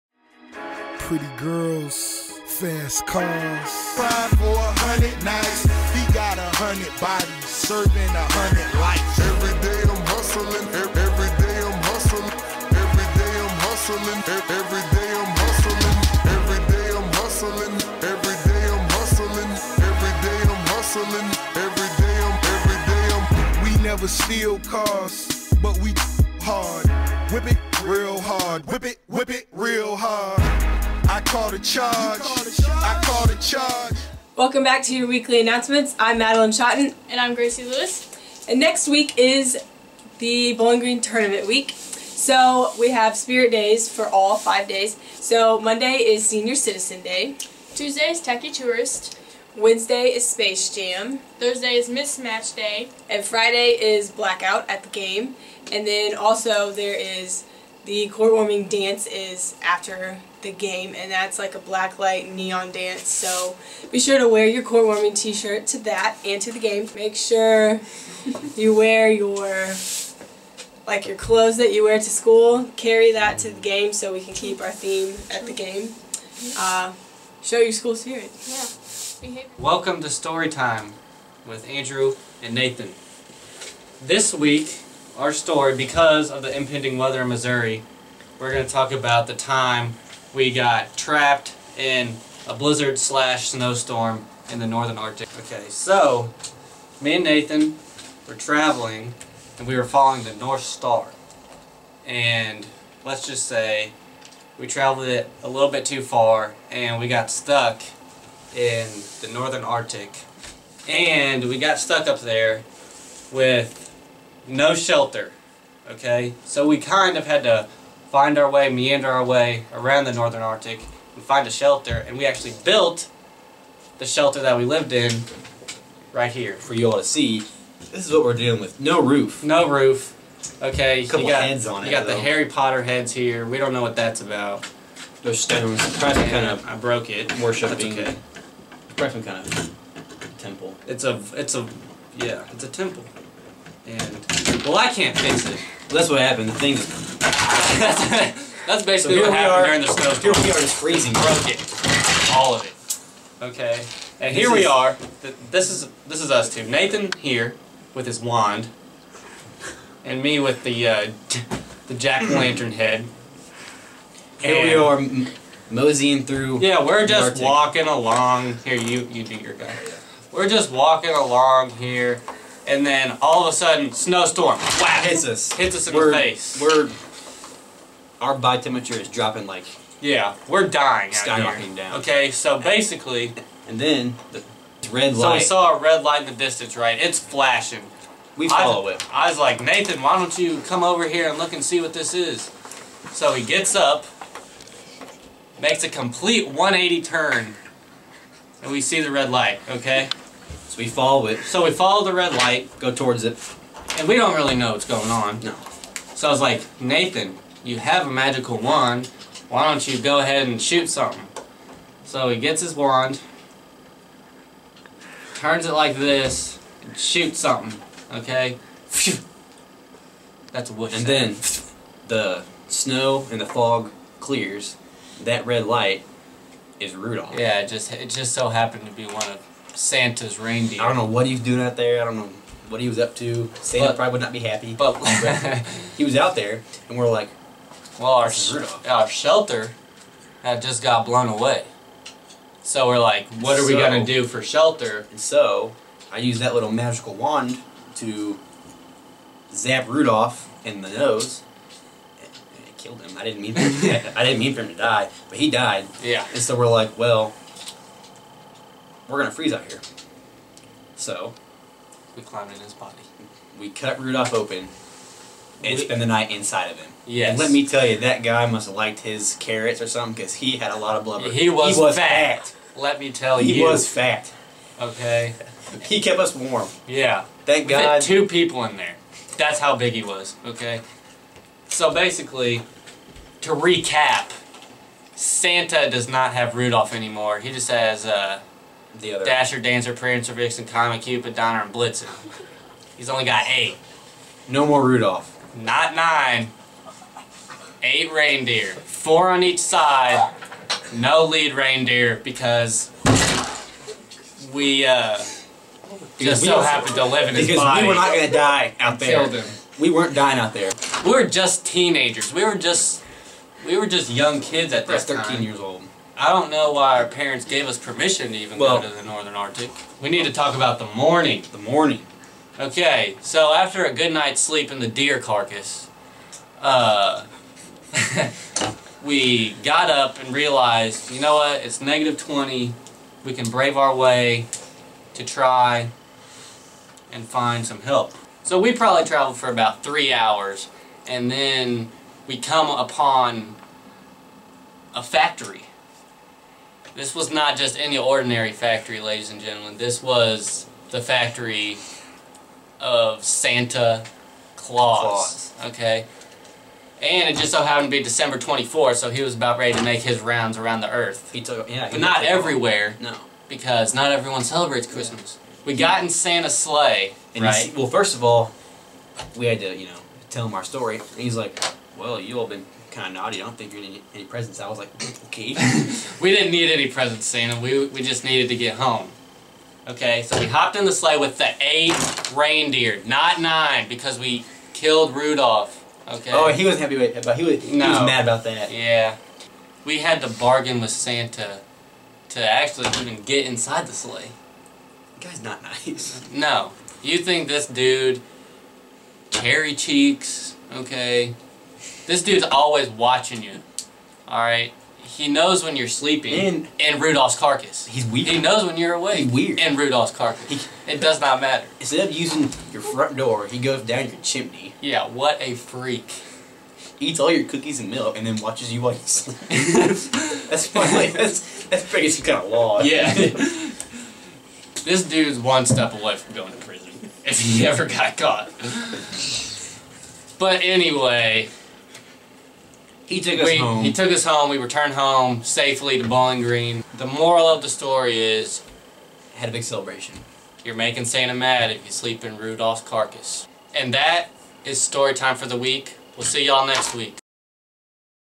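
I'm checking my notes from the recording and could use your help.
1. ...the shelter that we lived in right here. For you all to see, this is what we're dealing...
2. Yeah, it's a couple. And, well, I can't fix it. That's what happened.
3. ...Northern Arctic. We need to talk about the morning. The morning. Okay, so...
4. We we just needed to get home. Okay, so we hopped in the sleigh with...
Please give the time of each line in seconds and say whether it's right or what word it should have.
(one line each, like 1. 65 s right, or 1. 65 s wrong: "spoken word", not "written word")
1. 123 s right
2. 142 s wrong: "temple", not "couple"
3. 319 s right
4. 377 s right.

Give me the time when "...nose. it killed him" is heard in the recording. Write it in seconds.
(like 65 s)
250 s.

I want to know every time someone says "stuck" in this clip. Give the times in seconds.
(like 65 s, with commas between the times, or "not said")
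107 s, 111 s.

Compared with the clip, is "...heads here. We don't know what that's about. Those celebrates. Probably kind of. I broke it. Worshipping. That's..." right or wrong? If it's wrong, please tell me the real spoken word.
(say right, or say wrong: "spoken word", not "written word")
wrong: "stones", not "celebrates".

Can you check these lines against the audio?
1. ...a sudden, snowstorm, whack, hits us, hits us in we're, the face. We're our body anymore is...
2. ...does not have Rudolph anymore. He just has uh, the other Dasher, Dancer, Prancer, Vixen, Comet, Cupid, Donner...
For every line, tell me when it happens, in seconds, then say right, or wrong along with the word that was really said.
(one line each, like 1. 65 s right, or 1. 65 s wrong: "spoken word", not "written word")
1. 173 s wrong: "temperature", not "anymore"
2. 285 s right.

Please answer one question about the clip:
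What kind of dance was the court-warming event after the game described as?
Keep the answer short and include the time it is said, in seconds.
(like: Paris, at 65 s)
black light neon dance, at 61 s.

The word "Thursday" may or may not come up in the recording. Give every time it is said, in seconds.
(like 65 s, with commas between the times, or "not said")
51 s.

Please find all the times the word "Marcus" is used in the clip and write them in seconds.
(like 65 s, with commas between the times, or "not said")
not said.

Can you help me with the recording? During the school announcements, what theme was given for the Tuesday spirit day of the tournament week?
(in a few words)
Tacky Tourist.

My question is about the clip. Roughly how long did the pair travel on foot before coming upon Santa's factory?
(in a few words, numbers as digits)
about 3 hours.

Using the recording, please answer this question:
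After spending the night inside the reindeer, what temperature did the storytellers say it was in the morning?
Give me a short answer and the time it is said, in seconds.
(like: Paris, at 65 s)
-20, at 331 s.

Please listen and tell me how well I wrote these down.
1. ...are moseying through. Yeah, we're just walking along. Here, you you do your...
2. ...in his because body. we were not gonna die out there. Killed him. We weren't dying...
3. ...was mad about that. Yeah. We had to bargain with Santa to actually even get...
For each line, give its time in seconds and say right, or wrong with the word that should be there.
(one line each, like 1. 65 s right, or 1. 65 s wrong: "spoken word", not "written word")
1. 164 s right
2. 307 s right
3. 387 s right.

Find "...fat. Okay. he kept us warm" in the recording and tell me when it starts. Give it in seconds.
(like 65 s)
273 s.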